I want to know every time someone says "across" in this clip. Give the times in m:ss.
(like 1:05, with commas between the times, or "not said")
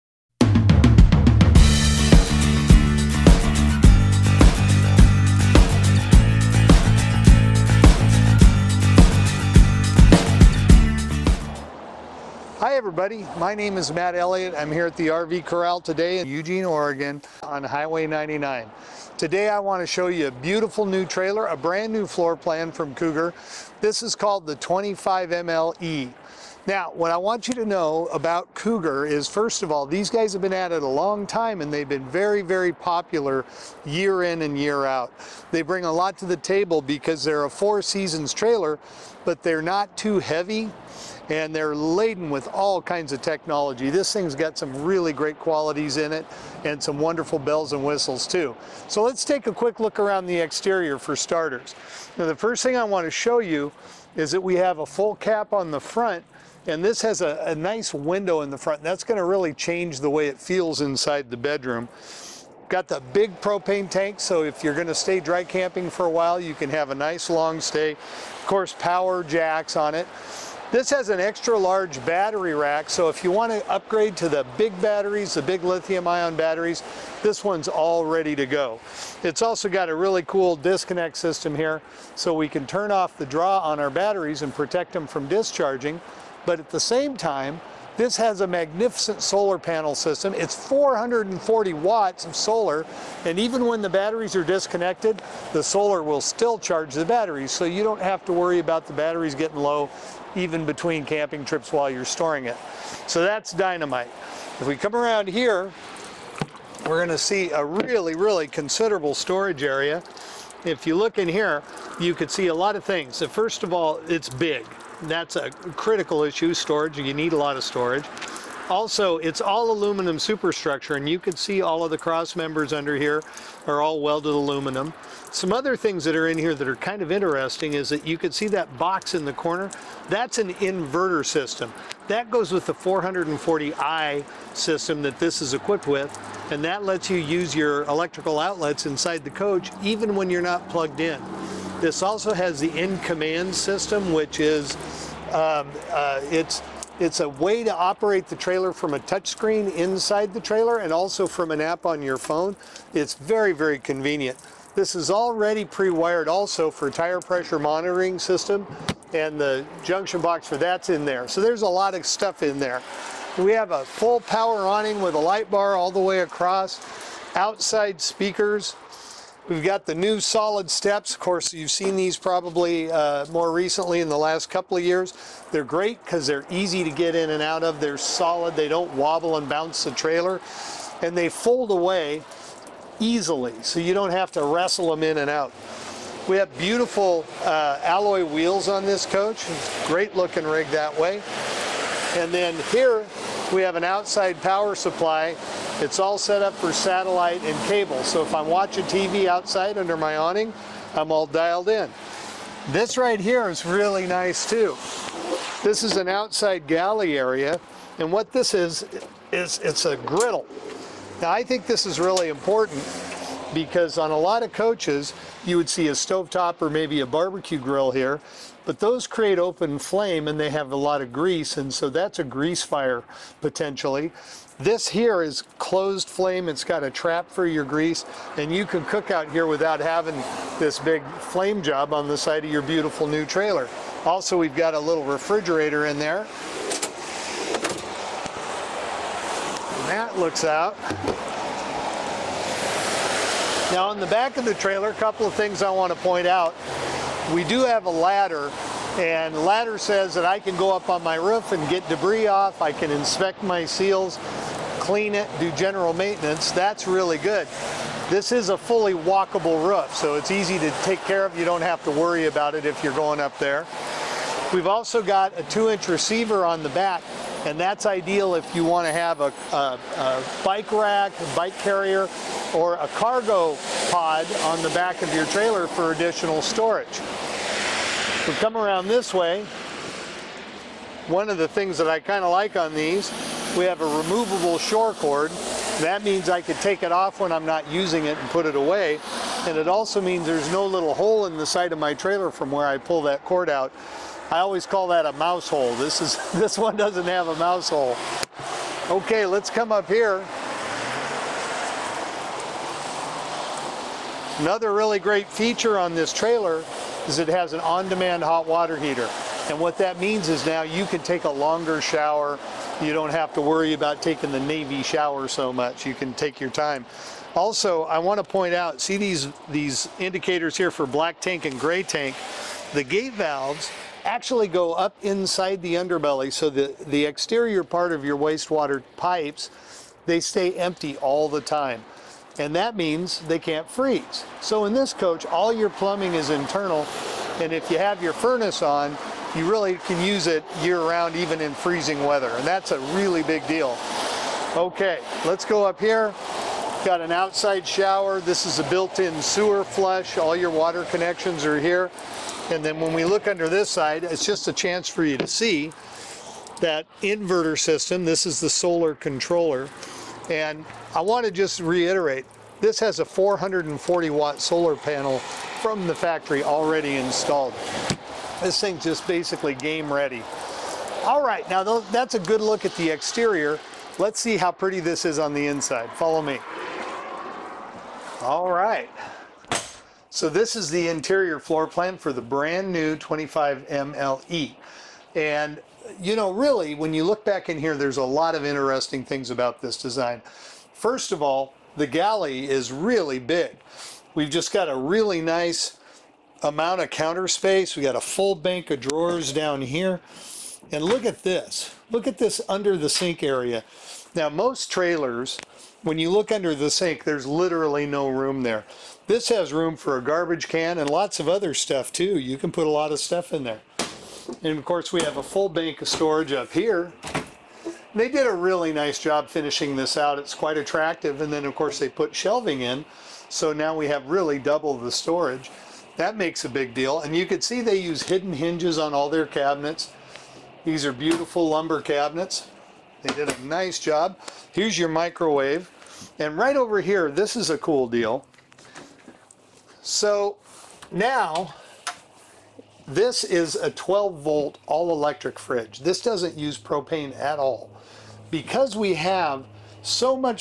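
2:46.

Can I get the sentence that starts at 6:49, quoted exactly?
This has room for a garbage can and lots of other stuff too.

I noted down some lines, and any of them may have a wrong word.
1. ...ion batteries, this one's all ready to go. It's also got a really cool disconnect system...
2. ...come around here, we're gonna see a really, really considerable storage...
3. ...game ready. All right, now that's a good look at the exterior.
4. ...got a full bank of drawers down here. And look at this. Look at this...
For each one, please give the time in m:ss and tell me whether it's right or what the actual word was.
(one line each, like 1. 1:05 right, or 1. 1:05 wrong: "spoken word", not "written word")
1. 1:16 right
2. 1:44 right
3. 6:09 right
4. 6:37 right.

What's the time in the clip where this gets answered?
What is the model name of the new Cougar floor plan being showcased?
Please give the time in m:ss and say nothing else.
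0:24.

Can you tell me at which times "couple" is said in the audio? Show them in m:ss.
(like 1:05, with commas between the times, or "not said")
2:54, 4:04.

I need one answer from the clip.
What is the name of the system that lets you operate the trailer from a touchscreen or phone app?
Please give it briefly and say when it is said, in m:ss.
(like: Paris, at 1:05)
In Command, at 2:22.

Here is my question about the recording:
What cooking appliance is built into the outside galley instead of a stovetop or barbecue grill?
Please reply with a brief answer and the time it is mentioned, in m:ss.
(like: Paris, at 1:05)
A griddle, at 3:29.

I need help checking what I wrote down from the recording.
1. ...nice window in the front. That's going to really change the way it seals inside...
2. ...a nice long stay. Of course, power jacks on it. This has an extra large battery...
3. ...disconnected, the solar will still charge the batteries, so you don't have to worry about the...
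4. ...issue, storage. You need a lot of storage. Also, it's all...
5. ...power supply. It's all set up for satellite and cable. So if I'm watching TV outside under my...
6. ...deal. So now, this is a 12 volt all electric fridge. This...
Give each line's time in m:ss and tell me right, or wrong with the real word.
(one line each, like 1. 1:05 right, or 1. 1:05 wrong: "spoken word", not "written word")
1. 0:57 wrong: "feels", not "seals"
2. 1:06 right
3. 1:34 right
4. 1:56 right
5. 3:14 right
6. 7:17 right.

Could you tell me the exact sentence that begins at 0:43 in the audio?
This thing's got some really great qualities in it and some wonderful bells and whistles too.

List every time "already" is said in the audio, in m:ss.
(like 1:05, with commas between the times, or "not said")
2:35, 6:06.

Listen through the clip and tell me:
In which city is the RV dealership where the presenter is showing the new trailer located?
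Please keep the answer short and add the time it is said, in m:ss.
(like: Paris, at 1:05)
Eugene, Oregon, at 0:16.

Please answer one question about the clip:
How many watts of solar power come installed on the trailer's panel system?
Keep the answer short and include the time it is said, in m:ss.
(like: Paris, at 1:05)
440 watts, at 1:30.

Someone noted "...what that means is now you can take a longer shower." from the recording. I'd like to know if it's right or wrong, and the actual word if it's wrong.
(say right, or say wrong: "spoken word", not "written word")
right.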